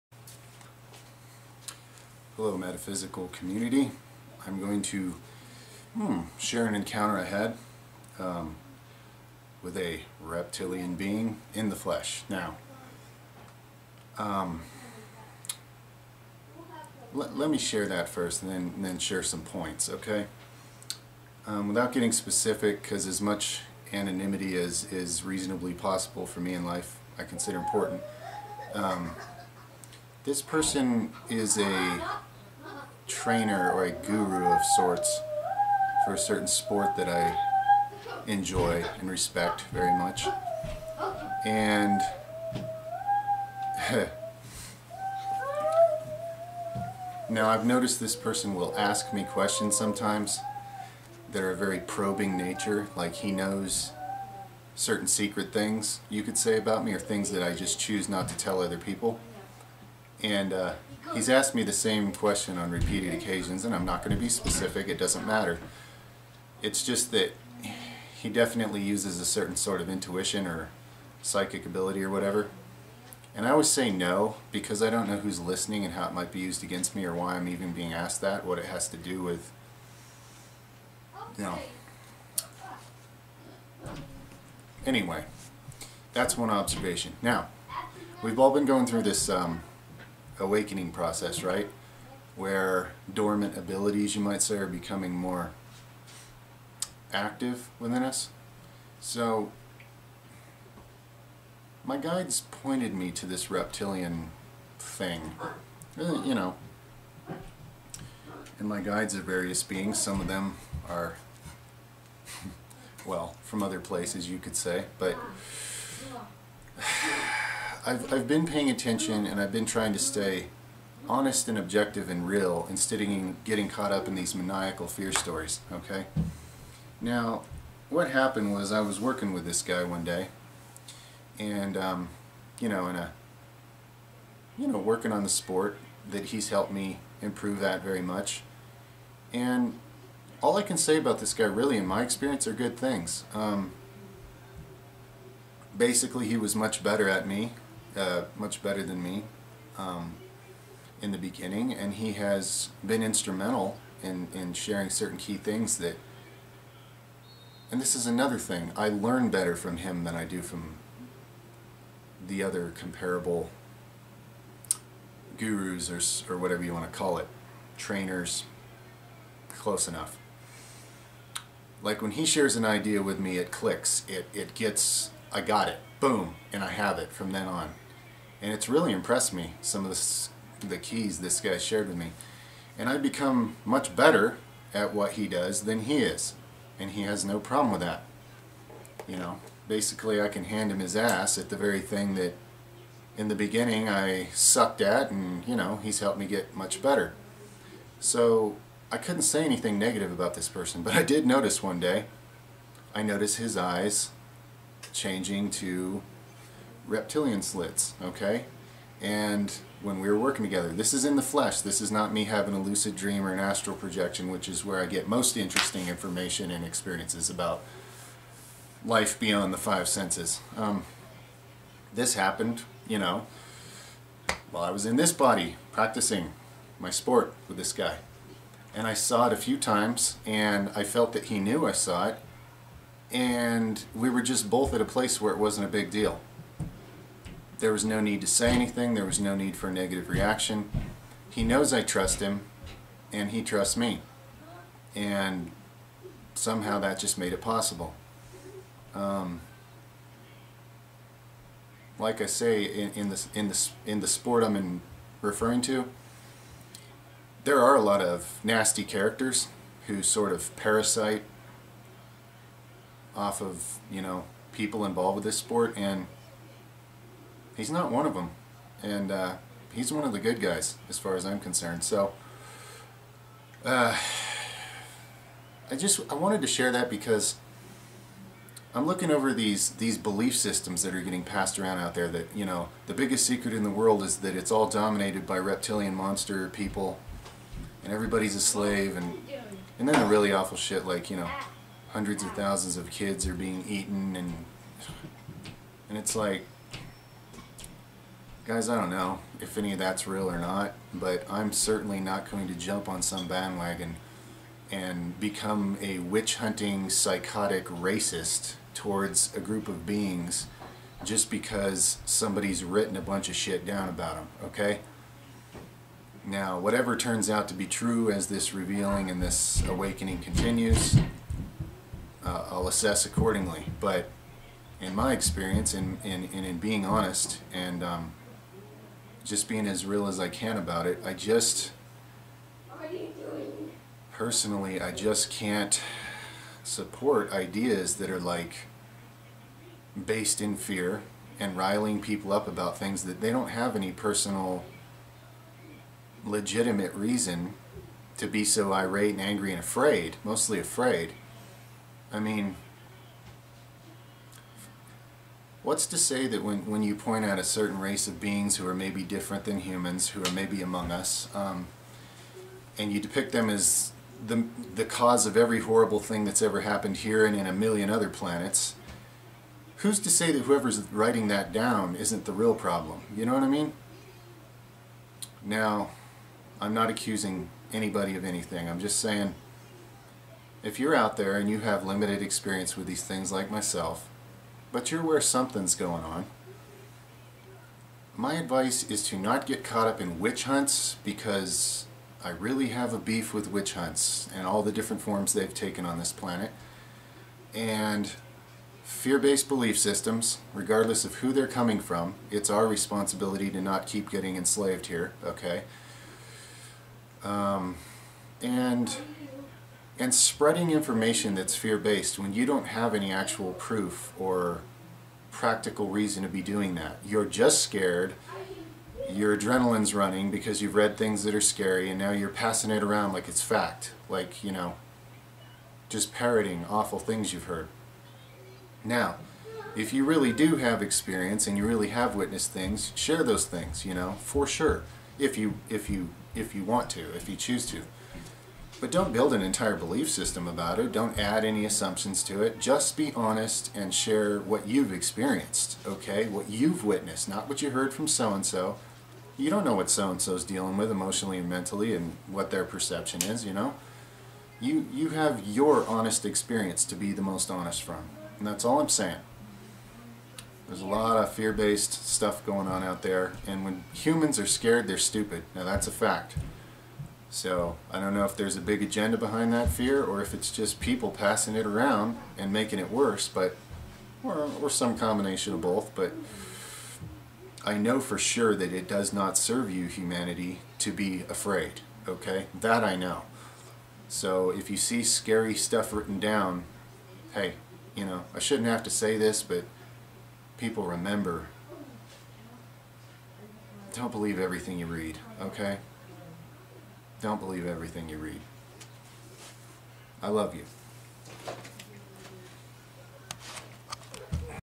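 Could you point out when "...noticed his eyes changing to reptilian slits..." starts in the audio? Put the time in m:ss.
3:23.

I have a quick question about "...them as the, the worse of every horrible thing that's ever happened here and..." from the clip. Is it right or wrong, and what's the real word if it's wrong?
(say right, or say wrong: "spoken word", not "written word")
wrong: "cause", not "worse".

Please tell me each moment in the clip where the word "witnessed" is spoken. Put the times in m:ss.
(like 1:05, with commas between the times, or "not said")
7:12, 7:26.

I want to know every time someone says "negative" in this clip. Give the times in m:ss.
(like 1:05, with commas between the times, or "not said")
3:19, 3:59.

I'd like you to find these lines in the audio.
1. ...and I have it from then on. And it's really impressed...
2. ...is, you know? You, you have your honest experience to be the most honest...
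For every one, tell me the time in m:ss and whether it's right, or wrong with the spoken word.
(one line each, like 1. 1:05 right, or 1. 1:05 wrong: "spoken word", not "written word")
1. 2:56 right
2. 7:33 right.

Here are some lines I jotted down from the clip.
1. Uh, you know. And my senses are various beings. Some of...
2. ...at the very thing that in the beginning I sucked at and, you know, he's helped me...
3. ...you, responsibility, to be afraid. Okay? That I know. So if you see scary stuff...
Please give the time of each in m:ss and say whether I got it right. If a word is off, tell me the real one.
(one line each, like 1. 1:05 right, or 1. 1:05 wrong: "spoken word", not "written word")
1. 1:45 wrong: "guides", not "senses"
2. 3:11 right
3. 7:59 wrong: "humanity", not "responsibility".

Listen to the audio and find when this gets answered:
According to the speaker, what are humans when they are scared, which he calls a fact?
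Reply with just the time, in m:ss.
7:44.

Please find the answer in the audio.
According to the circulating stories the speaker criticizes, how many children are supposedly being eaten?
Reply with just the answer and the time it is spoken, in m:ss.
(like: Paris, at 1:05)
hundreds of thousands, at 4:51.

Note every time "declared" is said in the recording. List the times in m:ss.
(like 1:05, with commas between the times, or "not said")
not said.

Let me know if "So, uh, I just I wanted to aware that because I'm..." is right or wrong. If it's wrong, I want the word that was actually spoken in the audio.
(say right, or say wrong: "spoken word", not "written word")
wrong: "share", not "aware".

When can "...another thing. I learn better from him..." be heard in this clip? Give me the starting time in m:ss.
2:38.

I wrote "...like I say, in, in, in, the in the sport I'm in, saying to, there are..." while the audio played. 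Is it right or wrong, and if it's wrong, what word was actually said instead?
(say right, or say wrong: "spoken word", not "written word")
wrong: "referring", not "saying".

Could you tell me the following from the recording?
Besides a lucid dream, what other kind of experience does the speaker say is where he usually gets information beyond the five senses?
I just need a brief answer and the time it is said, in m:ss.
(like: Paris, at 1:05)
astral projection, at 3:33.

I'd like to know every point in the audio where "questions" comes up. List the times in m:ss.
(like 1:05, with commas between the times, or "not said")
0:49, 1:02.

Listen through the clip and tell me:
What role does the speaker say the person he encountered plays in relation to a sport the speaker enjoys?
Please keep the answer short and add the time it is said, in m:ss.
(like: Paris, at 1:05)
trainer, at 0:33.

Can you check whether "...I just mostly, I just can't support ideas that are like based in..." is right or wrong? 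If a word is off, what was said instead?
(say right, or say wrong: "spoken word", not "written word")
wrong: "personally", not "mostly".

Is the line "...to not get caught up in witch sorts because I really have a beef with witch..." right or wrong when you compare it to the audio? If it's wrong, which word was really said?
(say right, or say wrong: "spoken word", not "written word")
wrong: "hunts", not "sorts".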